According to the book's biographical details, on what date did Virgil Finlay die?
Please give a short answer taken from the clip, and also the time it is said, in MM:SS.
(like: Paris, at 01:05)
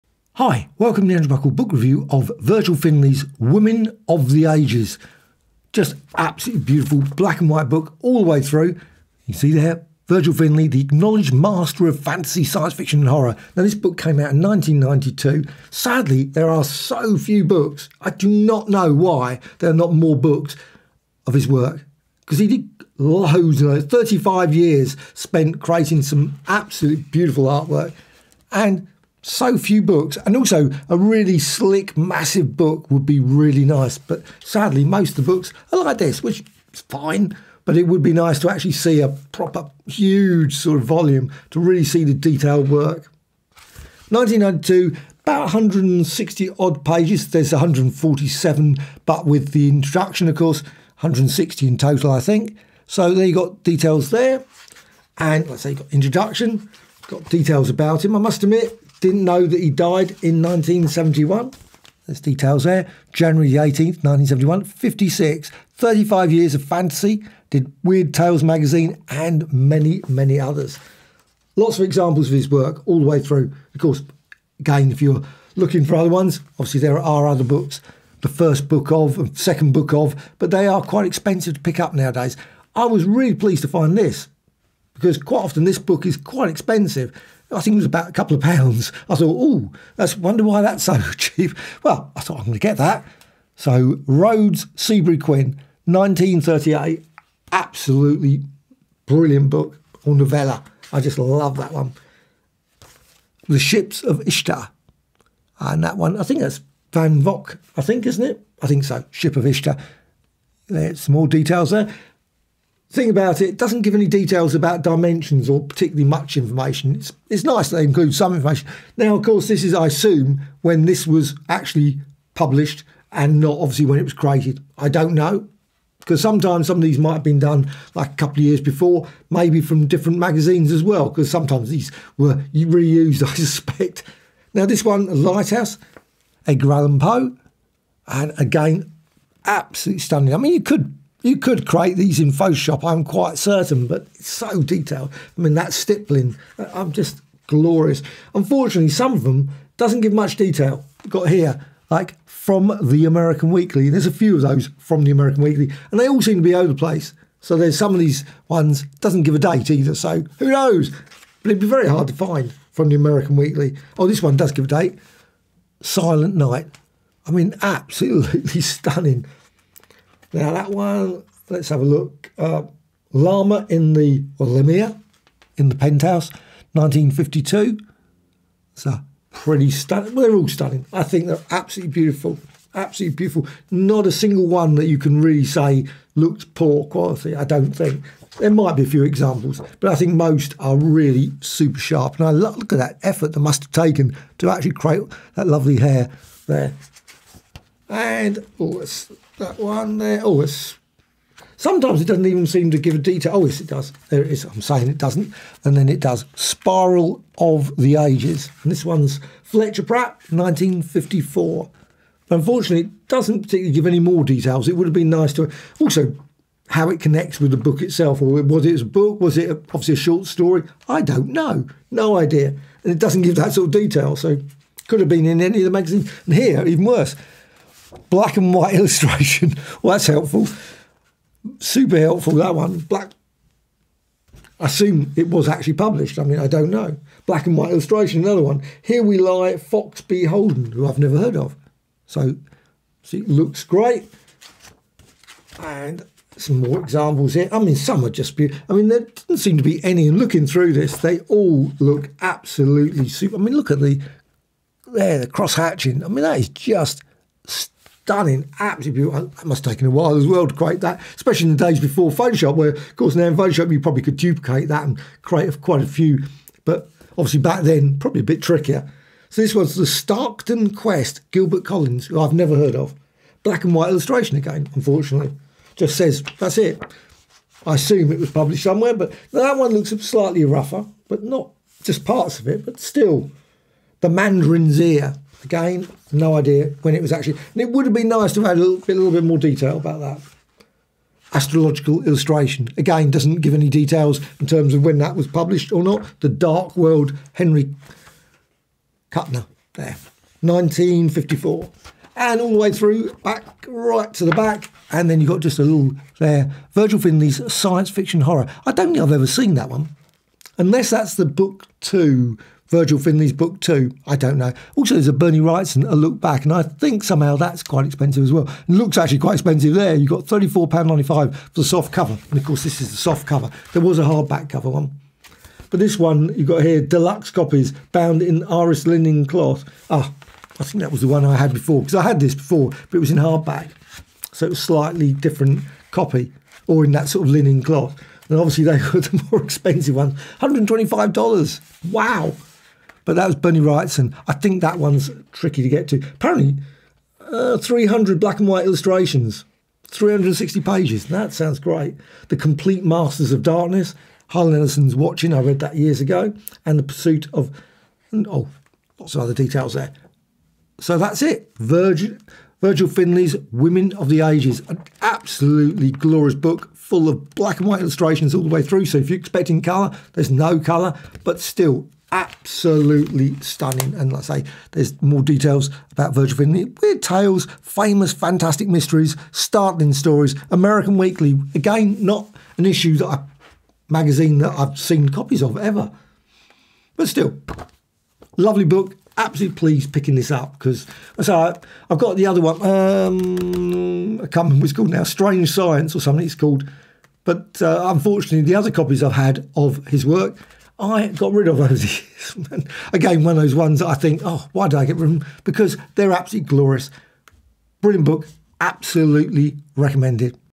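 January 18th, 1971, at 01:03.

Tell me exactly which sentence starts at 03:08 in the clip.
There might be a few examples, but I think most are really super sharp.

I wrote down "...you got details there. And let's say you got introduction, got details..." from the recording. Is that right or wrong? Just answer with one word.
right.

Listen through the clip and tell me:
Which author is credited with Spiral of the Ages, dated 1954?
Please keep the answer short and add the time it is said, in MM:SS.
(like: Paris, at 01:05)
Fletcher Pratt, at 03:29.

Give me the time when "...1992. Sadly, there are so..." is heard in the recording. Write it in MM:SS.
00:14.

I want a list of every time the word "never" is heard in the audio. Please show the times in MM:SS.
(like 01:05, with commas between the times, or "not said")
04:00, 04:32.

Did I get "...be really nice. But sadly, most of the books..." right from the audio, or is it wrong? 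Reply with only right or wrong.
right.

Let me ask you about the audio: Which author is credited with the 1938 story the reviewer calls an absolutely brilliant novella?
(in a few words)
Seabury Quinn.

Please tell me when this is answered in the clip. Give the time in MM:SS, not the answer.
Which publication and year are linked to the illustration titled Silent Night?
02:55.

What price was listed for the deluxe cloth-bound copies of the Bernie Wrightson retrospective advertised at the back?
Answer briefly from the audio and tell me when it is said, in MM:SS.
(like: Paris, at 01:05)
$125, at 05:40.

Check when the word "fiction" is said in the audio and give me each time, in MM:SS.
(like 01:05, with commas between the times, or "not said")
00:12, 05:07.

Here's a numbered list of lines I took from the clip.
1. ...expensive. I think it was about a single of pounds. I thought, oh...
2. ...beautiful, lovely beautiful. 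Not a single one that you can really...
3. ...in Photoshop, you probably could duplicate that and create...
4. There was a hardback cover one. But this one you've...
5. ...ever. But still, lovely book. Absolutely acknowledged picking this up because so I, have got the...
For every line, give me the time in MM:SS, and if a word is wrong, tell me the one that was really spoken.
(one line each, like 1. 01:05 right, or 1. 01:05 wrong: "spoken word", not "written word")
1. 01:26 wrong: "couple", not "single"
2. 03:01 wrong: "absolutely", not "lovely"
3. 04:23 right
4. 05:23 right
5. 06:25 wrong: "pleased", not "acknowledged".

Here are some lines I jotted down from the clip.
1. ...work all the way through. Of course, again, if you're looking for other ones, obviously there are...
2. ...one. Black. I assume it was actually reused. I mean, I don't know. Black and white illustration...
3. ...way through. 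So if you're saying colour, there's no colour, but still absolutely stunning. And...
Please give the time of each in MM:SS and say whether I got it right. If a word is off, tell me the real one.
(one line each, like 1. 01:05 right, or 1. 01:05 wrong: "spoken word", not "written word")
1. 01:12 right
2. 03:52 wrong: "published", not "reused"
3. 06:08 wrong: "expecting", not "saying".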